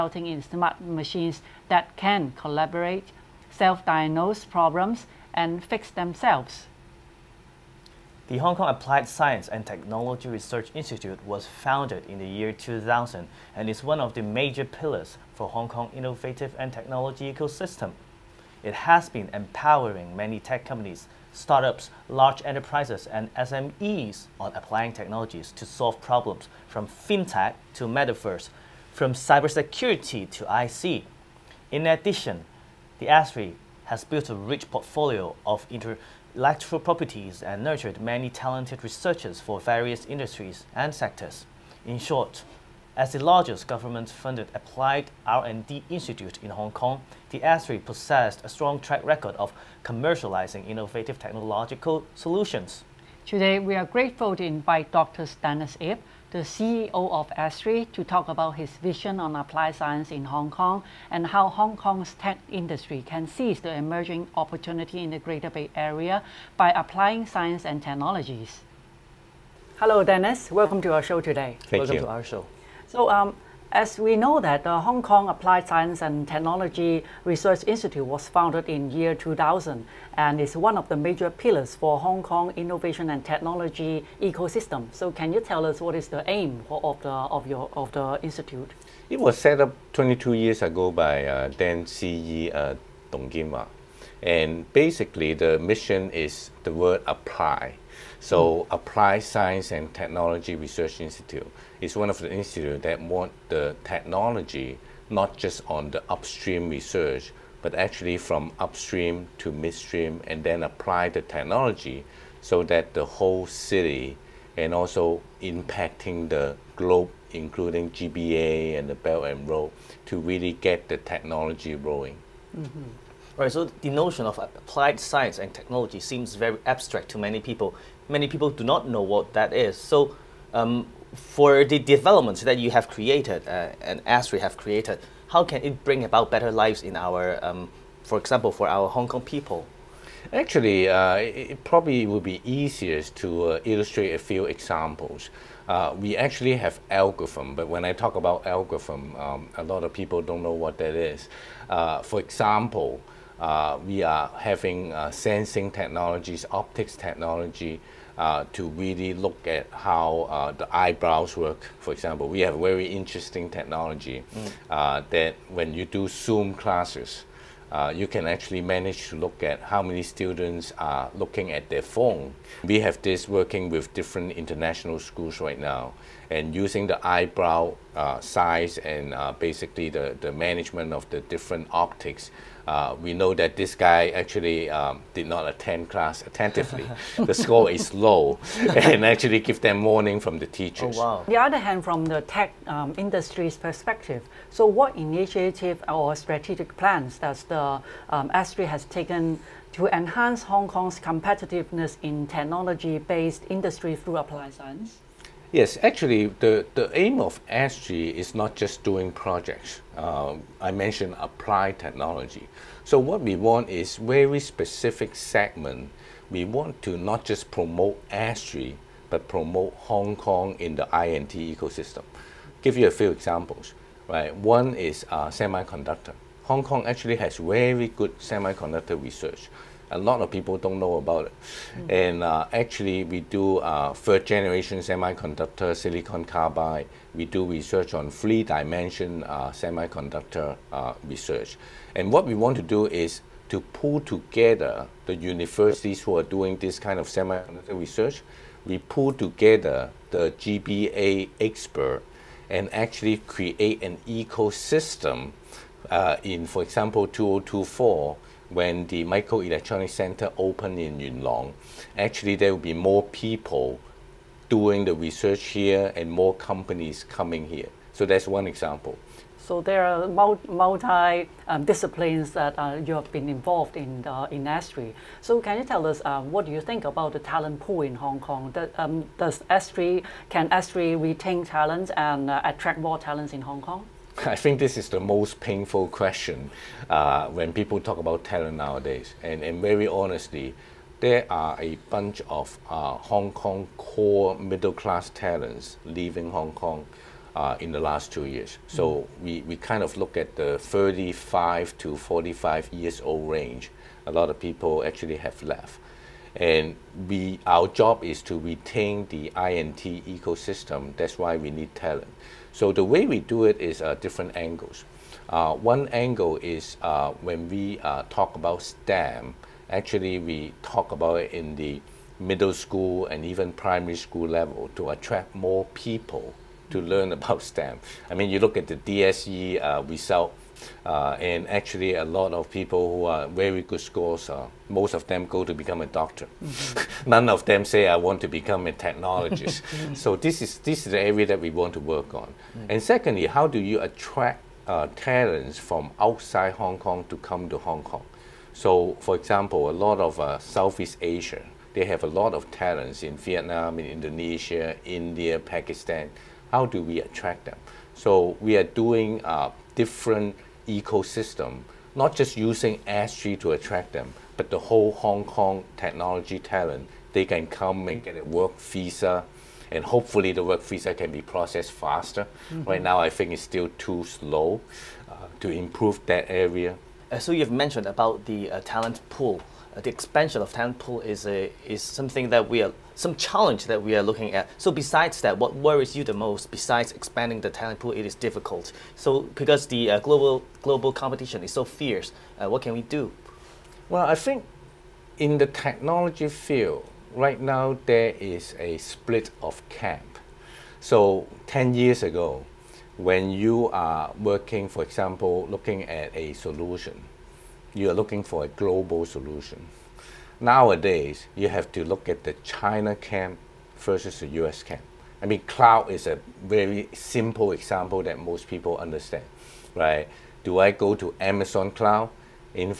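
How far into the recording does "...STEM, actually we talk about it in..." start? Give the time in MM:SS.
05:18.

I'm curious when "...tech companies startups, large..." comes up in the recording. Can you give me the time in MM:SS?
00:20.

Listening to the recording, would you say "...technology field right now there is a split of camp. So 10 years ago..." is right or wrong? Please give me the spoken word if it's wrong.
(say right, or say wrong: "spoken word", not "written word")
right.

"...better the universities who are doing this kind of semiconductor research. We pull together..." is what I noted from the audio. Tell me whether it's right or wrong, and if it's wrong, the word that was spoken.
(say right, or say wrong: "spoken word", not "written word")
wrong: "together", not "better".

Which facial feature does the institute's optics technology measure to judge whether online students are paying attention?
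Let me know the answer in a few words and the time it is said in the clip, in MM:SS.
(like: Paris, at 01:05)
eyebrow, at 02:57.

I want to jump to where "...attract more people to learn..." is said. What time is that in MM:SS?
05:24.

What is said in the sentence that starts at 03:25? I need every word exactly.
Yes, actually, the, the aim of SG is not just doing projects.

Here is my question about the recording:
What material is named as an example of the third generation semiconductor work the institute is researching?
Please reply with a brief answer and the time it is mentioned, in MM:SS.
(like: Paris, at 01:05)
silicon carbide, at 03:55.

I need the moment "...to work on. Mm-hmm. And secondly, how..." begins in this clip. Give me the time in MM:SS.
05:41.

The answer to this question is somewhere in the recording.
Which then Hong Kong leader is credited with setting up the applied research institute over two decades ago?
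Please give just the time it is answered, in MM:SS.
01:33.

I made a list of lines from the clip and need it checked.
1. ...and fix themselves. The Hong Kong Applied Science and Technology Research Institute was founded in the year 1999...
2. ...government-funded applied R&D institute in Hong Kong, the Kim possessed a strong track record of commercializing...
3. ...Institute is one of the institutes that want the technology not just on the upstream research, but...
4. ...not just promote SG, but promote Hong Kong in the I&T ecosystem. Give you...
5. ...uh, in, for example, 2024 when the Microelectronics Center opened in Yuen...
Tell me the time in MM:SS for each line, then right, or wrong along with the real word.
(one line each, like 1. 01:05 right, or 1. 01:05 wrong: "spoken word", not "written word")
1. 00:05 wrong: "2000", not "1999"
2. 00:43 wrong: "ASTRI", not "Kim"
3. 01:40 right
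4. 03:36 right
5. 04:15 right.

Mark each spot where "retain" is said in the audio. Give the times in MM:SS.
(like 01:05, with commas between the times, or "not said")
04:40, 05:08.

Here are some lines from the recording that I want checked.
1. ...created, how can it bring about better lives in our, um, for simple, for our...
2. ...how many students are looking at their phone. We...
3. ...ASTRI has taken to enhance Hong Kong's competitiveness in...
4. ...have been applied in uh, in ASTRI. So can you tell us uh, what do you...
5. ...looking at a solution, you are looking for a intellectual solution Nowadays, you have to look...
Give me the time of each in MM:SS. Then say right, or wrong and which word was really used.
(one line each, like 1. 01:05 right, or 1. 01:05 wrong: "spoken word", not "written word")
1. 02:14 wrong: "example", not "simple"
2. 02:49 right
3. 03:18 right
4. 04:32 wrong: "involved", not "applied"
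5. 06:45 wrong: "global", not "intellectual".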